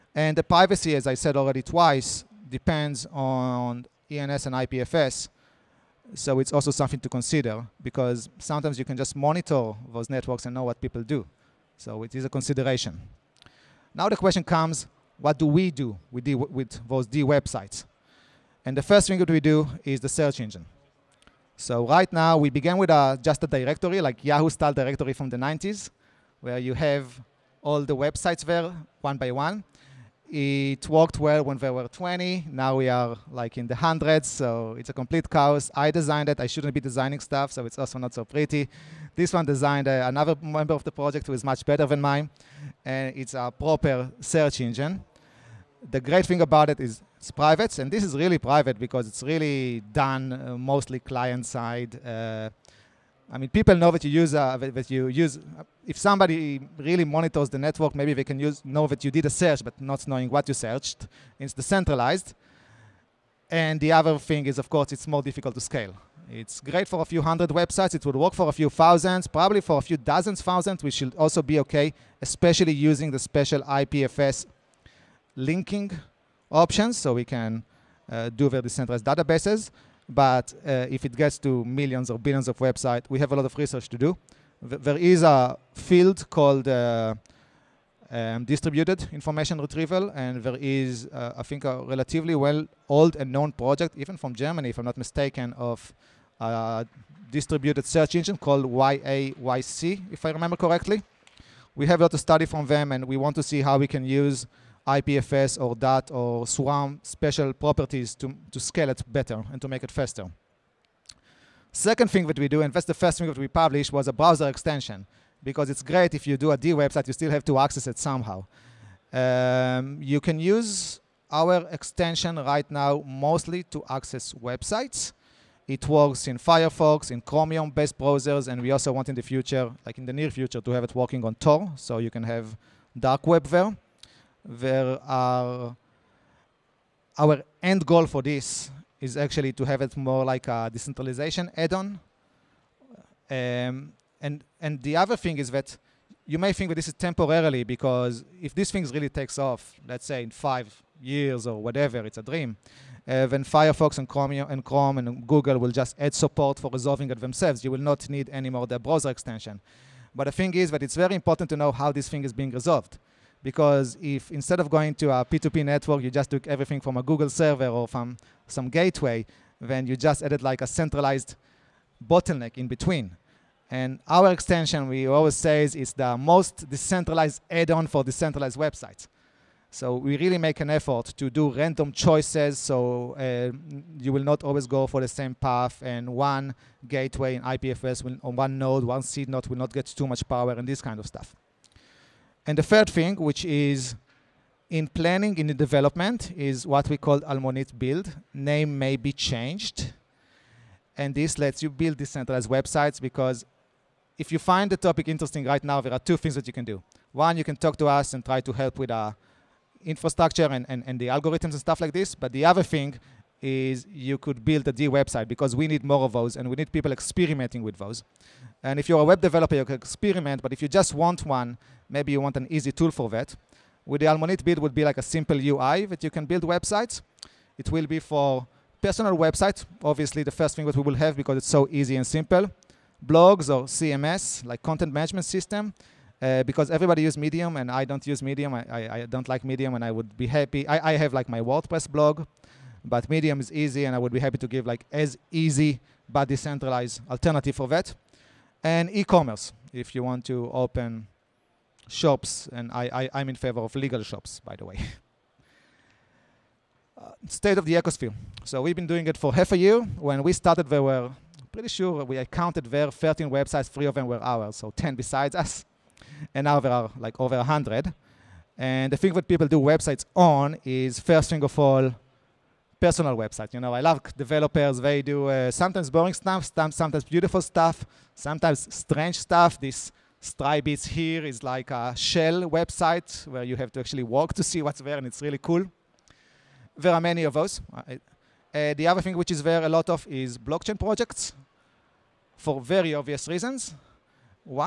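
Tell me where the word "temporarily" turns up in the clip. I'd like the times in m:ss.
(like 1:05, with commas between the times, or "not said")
2:26.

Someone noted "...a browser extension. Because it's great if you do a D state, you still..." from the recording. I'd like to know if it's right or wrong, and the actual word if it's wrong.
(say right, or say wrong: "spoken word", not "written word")
wrong: "website", not "state".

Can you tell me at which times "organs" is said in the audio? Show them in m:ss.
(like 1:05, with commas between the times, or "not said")
not said.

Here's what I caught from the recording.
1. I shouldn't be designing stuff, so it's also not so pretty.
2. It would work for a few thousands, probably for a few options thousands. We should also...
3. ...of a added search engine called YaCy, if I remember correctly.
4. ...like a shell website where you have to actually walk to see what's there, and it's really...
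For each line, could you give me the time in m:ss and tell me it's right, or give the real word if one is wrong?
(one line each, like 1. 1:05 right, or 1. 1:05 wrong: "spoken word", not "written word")
1. 0:36 right
2. 1:07 wrong: "dozens", not "options"
3. 1:35 wrong: "distributed", not "added"
4. 4:41 right.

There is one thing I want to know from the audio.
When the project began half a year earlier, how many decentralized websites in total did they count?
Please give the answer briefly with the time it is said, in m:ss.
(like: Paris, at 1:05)
13, at 4:22.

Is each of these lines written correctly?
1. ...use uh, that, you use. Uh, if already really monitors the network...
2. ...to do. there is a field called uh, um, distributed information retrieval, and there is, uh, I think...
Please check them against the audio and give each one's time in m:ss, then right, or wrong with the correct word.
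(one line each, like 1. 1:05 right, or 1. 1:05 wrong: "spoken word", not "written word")
1. 0:54 wrong: "somebody", not "already"
2. 1:23 right.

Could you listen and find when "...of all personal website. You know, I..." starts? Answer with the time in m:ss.
4:31.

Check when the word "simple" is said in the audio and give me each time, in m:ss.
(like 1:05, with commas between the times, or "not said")
3:45, 3:52.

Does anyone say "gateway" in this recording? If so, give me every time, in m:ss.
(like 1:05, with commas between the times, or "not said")
2:48, 3:06.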